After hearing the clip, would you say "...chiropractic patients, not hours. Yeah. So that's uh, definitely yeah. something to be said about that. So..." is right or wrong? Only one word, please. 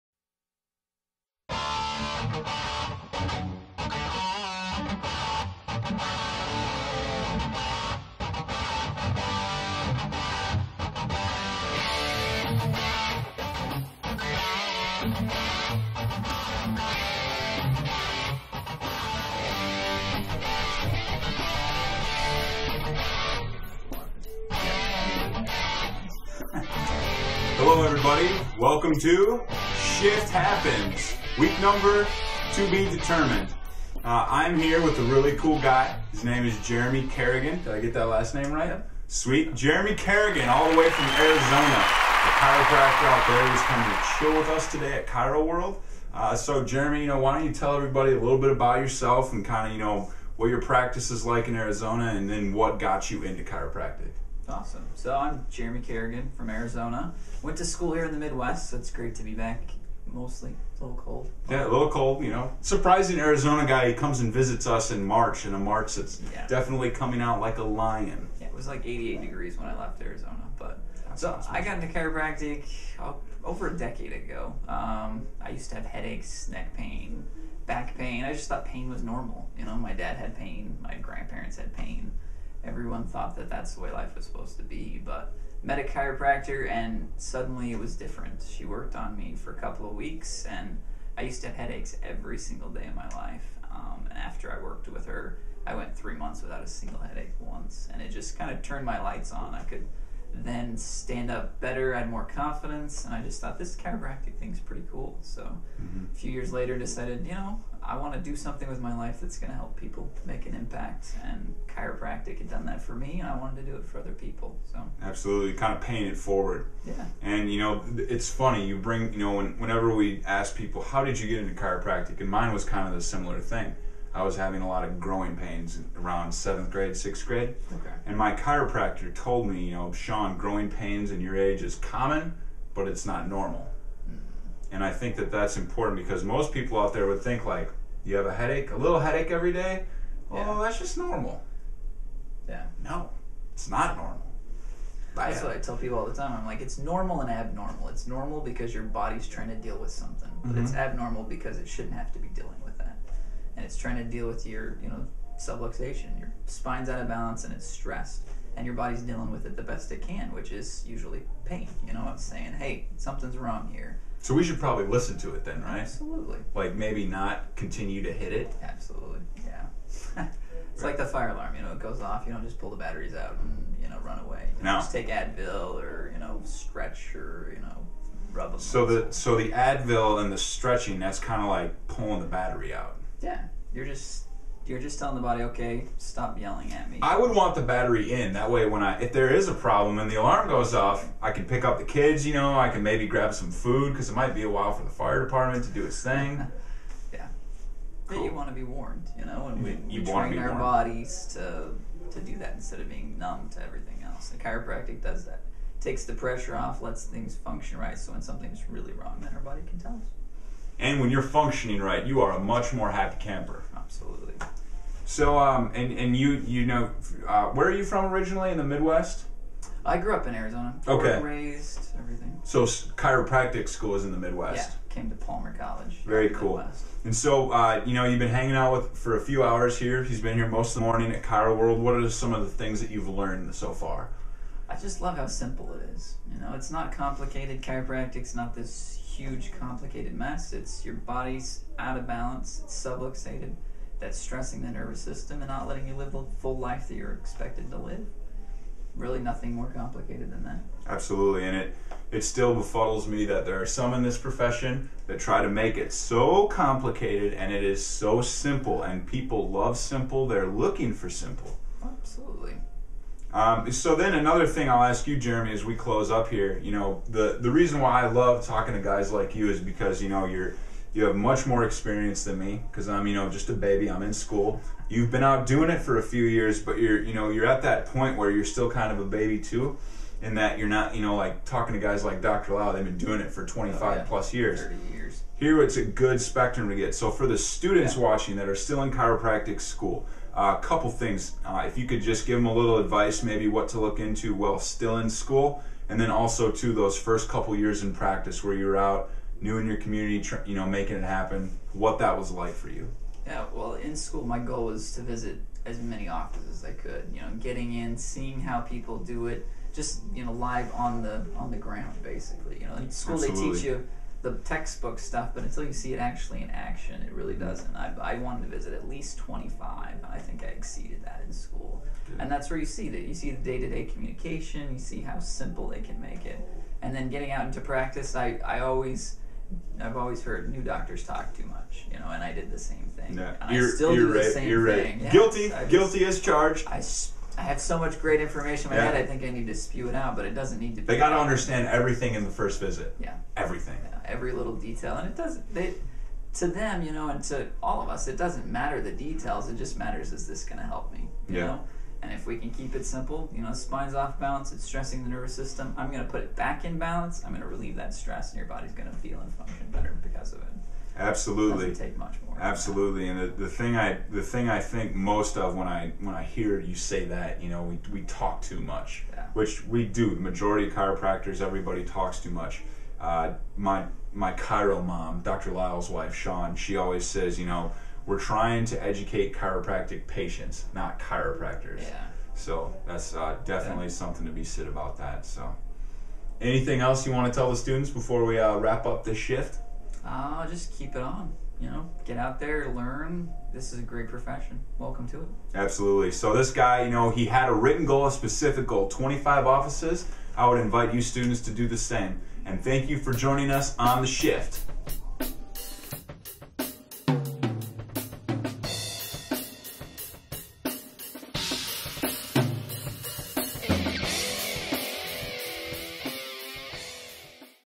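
wrong.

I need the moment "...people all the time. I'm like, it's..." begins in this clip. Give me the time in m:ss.
2:25.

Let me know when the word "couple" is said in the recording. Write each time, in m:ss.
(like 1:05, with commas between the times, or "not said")
1:29, 4:50, 4:57.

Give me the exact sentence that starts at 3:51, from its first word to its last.
What are some of the things that you've learned so far?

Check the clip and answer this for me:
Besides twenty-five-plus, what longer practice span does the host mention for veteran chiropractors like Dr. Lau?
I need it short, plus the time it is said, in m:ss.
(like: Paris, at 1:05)
30 years, at 4:44.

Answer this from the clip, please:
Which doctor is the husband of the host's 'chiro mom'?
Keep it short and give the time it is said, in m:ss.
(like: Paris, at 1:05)
Dr. Lyle, at 6:15.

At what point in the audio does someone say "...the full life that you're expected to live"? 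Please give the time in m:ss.
4:06.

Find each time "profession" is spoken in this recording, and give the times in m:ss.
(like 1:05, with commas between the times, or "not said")
4:14, 6:34.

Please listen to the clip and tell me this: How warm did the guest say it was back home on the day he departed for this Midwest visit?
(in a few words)
88 degrees.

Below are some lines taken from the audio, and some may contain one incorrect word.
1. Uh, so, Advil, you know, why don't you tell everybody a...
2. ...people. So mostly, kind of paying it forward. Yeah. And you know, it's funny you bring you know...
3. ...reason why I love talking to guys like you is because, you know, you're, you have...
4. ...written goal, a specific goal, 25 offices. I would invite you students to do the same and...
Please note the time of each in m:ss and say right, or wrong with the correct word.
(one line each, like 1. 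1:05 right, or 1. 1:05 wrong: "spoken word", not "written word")
1. 0:46 wrong: "Jeremy", not "Advil"
2. 1:54 wrong: "absolutely", not "mostly"
3. 4:27 right
4. 6:37 right.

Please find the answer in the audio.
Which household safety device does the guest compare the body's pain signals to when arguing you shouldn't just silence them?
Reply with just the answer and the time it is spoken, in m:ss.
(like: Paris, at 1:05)
Fire alarm, at 2:51.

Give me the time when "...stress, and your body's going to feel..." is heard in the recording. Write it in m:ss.
5:57.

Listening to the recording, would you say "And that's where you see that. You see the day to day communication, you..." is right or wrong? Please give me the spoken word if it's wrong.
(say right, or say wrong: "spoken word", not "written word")
right.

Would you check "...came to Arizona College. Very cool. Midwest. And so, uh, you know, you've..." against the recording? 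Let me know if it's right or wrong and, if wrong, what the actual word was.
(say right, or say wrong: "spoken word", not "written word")
wrong: "Palmer", not "Arizona".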